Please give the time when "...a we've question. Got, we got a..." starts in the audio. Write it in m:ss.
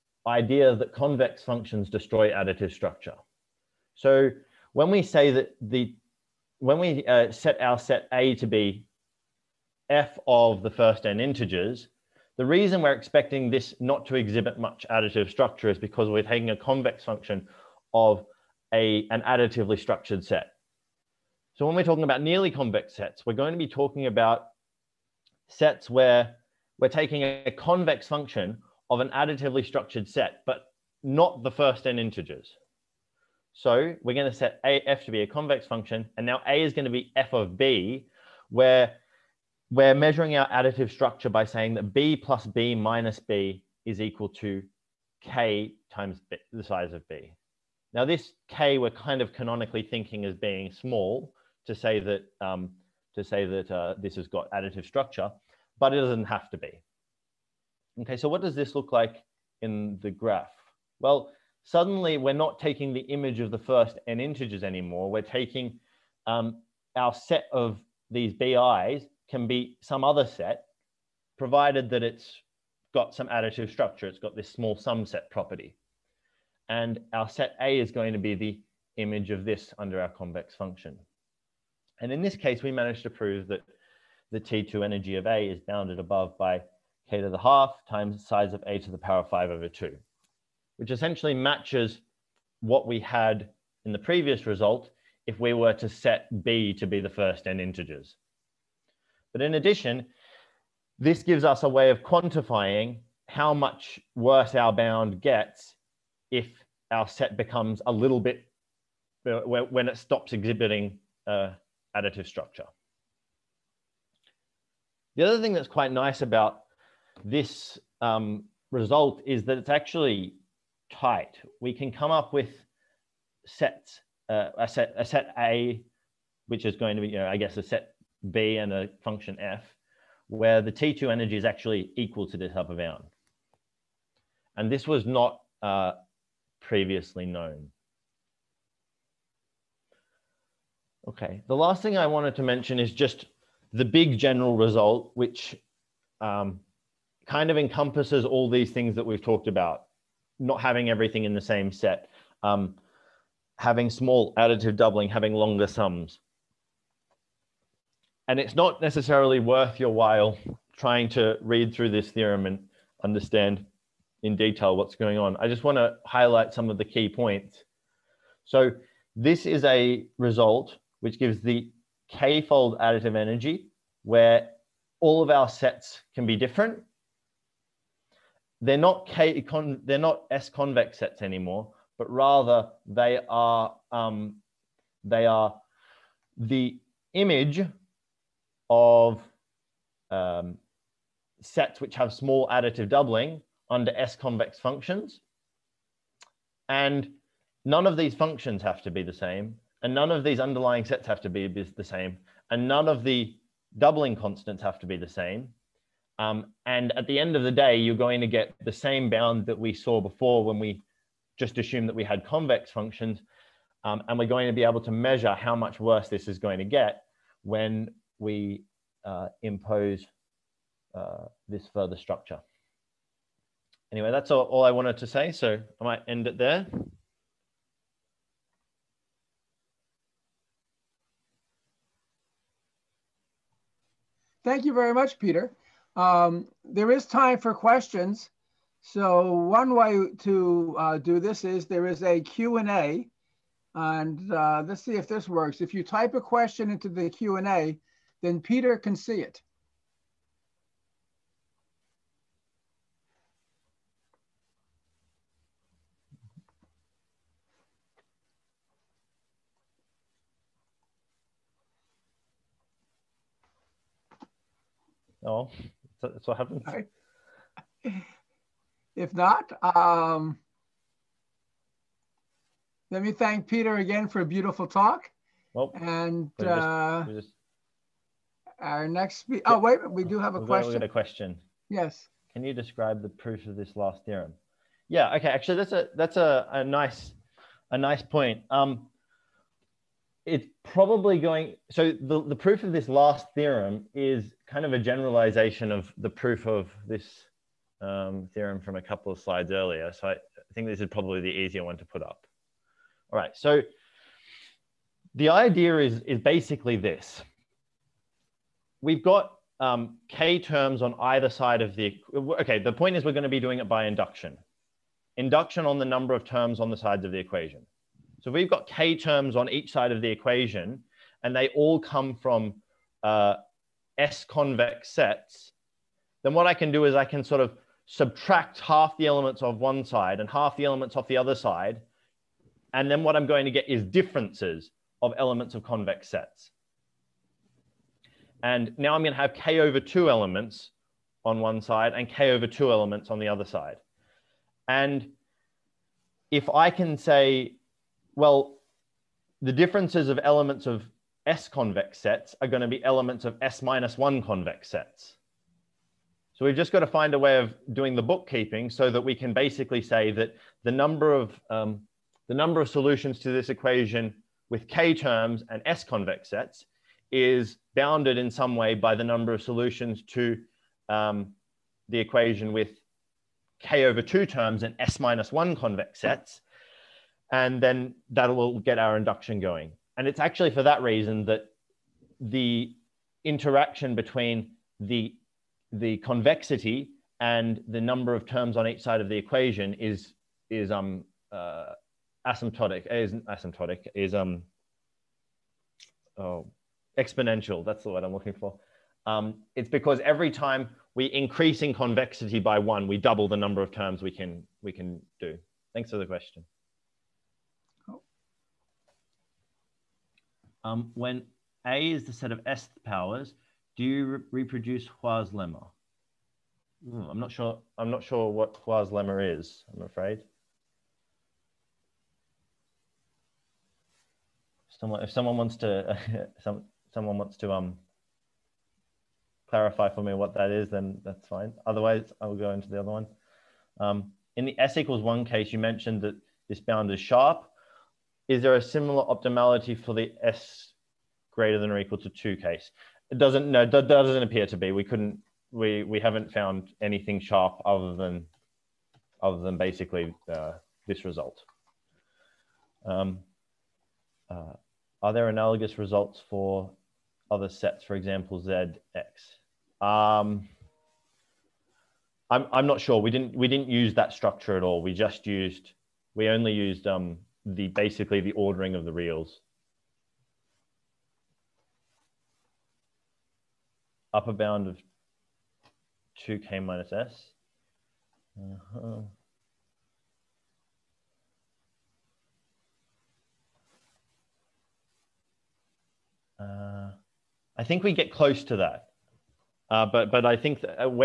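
4:40.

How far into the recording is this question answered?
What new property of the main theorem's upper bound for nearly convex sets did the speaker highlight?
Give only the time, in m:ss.
1:59.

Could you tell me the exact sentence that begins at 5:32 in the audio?
And then what I'm going to get is differences of elements of convex sets.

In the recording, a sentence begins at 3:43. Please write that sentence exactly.
Anyway, that's all, all I wanted to say.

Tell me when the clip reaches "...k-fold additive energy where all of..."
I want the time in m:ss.
2:52.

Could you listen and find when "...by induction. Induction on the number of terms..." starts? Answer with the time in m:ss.
5:13.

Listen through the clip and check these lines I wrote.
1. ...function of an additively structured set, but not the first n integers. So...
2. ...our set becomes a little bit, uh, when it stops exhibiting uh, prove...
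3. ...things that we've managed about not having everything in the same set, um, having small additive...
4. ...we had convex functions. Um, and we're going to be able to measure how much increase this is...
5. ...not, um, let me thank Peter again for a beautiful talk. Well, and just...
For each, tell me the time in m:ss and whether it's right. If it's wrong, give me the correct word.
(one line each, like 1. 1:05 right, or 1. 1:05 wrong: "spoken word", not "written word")
1. 0:28 right
2. 1:46 wrong: "additive", not "prove"
3. 2:28 wrong: "talked", not "managed"
4. 3:31 wrong: "worse", not "increase"
5. 4:29 right.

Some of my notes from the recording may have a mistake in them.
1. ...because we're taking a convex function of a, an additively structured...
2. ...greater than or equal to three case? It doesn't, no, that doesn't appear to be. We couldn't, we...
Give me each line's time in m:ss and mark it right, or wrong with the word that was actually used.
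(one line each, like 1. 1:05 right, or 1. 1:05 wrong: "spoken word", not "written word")
1. 0:15 right
2. 7:21 wrong: "two", not "three".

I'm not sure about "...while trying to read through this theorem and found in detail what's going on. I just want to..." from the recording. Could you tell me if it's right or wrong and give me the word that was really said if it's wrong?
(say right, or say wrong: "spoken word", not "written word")
wrong: "understand", not "found".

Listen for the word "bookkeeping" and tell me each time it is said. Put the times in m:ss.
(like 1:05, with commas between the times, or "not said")
5:58.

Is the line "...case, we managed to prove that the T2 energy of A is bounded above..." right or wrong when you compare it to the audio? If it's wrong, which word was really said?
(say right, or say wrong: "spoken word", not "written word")
right.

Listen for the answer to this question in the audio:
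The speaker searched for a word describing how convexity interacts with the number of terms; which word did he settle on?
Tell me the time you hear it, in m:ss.
6:36.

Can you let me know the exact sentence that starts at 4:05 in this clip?
If you type a question into the Q&A, then Peter can see it.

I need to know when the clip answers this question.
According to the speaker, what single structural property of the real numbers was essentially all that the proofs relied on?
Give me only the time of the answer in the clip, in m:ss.
7:48.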